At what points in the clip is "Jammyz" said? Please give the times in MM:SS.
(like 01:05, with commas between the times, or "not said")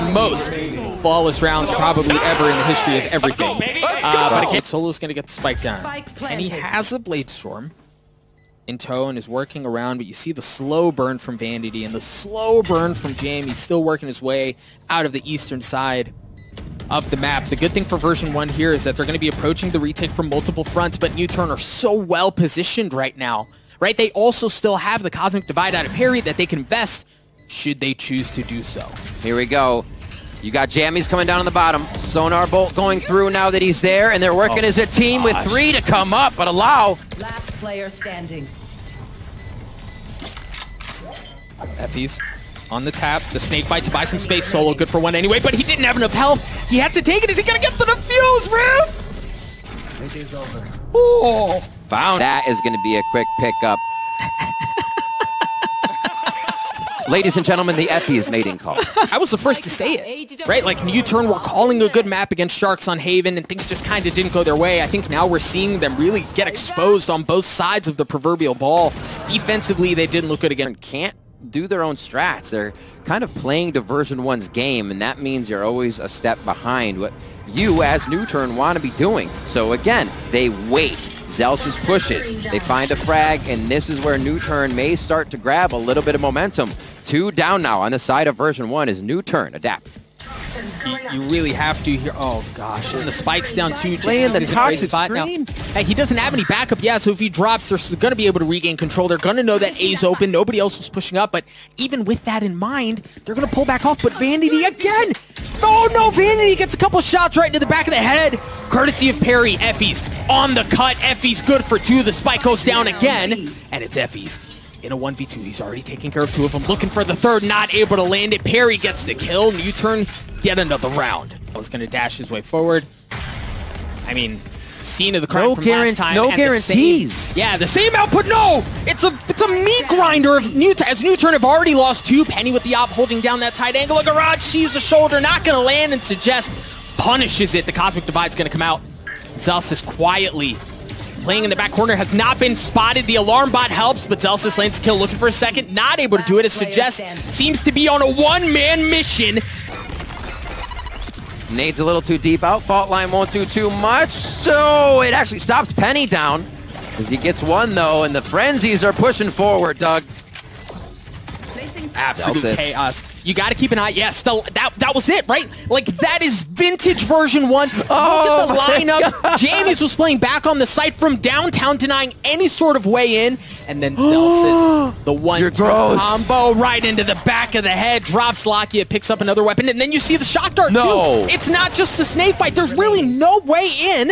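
00:30, 02:49.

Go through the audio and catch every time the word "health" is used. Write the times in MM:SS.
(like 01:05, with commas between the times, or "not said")
00:46.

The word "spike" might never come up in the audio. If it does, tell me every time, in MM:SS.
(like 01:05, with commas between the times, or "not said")
00:05, 01:33, 01:52.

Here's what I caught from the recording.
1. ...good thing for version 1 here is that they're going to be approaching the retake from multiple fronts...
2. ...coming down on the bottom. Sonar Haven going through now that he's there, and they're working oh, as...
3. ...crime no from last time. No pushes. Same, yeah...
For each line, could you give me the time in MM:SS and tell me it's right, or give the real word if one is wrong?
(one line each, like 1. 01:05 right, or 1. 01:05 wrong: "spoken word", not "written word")
1. 00:17 right
2. 00:31 wrong: "Bolt", not "Haven"
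3. 02:05 wrong: "guarantees", not "pushes".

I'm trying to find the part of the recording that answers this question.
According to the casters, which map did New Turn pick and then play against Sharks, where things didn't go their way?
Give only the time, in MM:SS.
01:02.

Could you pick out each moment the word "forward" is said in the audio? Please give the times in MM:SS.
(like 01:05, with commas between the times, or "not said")
02:02, 02:39.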